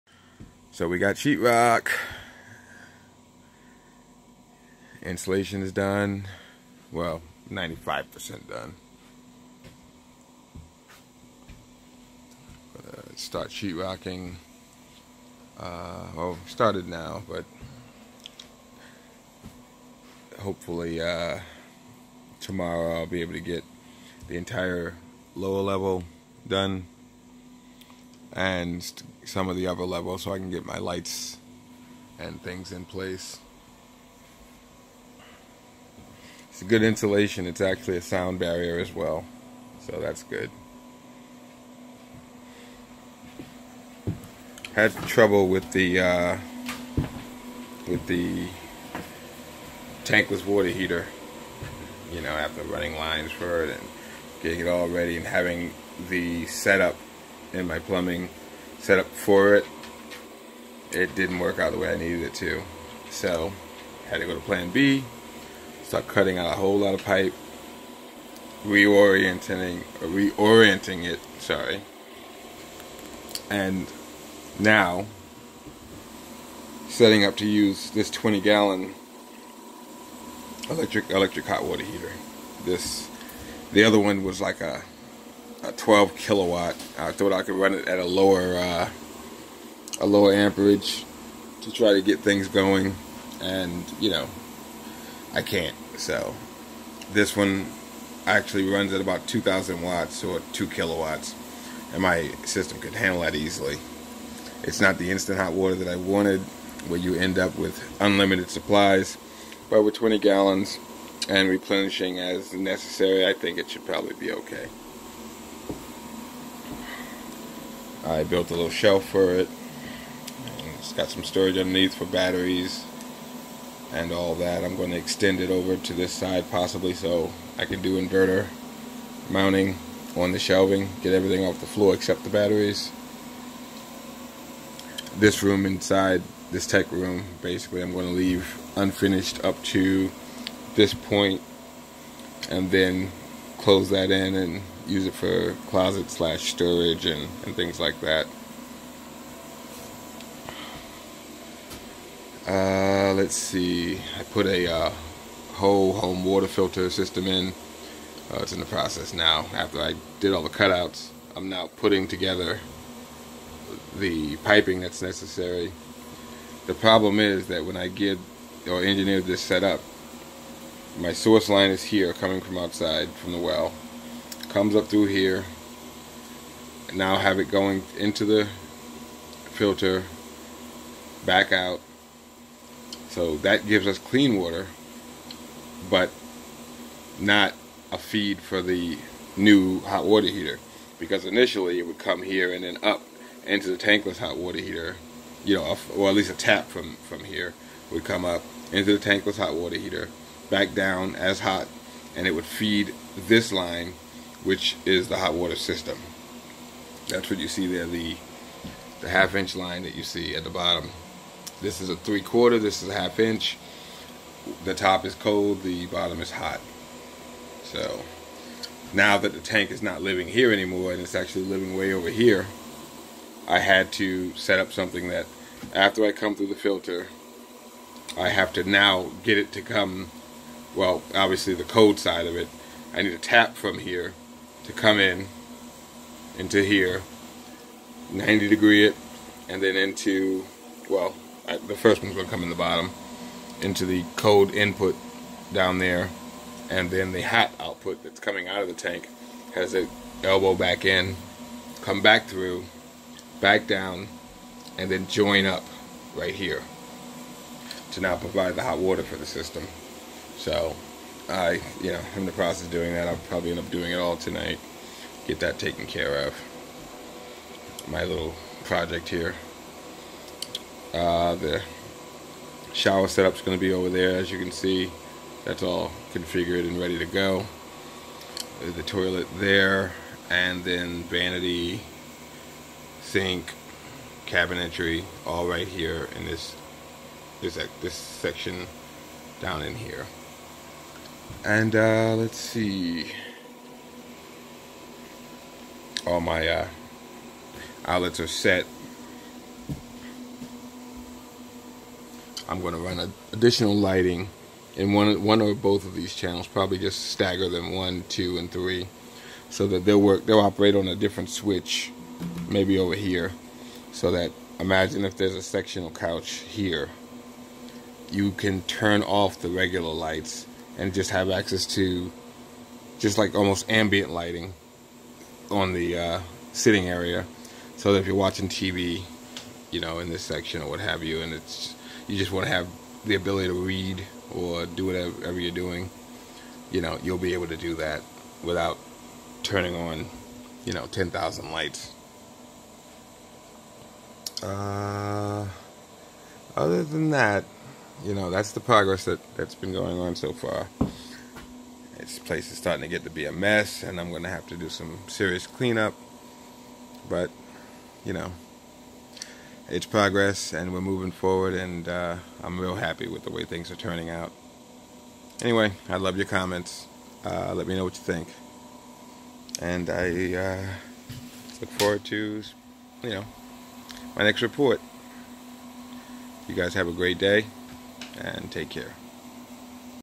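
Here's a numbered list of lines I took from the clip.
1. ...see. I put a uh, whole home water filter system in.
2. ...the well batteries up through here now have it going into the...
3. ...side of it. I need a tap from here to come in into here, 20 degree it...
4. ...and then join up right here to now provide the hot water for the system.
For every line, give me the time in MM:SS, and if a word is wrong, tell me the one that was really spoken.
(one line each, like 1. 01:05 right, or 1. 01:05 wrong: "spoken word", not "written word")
1. 02:33 right
2. 02:53 wrong: "comes", not "batteries"
3. 03:51 wrong: "90", not "20"
4. 04:14 right.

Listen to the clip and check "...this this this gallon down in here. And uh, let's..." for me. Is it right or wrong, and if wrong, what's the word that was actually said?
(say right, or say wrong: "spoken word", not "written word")
wrong: "section", not "gallon".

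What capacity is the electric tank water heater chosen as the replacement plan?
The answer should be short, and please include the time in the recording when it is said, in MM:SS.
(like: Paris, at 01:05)
20 gallons, at 01:18.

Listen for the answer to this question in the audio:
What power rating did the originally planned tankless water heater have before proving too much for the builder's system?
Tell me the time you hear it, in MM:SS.
01:25.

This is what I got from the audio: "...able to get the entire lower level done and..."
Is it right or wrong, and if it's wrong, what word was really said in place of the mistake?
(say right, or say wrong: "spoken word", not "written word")
right.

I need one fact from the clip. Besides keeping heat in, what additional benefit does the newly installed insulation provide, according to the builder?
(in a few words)
Sound barrier.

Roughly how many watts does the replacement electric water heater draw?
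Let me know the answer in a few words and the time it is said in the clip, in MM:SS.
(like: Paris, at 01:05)
2,000 watts, at 01:39.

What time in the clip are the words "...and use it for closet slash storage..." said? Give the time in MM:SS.
02:24.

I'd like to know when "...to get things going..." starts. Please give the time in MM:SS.
01:31.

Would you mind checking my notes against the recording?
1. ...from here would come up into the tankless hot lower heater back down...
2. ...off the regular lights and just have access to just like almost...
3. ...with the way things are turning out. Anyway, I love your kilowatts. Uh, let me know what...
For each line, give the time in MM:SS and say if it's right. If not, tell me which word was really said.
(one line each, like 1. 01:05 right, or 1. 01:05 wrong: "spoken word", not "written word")
1. 03:17 wrong: "water", not "lower"
2. 05:19 right
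3. 06:03 wrong: "comments", not "kilowatts".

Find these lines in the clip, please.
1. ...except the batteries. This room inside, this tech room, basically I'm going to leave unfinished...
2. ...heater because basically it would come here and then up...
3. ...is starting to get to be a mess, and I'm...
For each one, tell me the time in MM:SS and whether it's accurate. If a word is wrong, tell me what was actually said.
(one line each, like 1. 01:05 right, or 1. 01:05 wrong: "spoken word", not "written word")
1. 02:11 right
2. 03:10 wrong: "initially", not "basically"
3. 05:52 right.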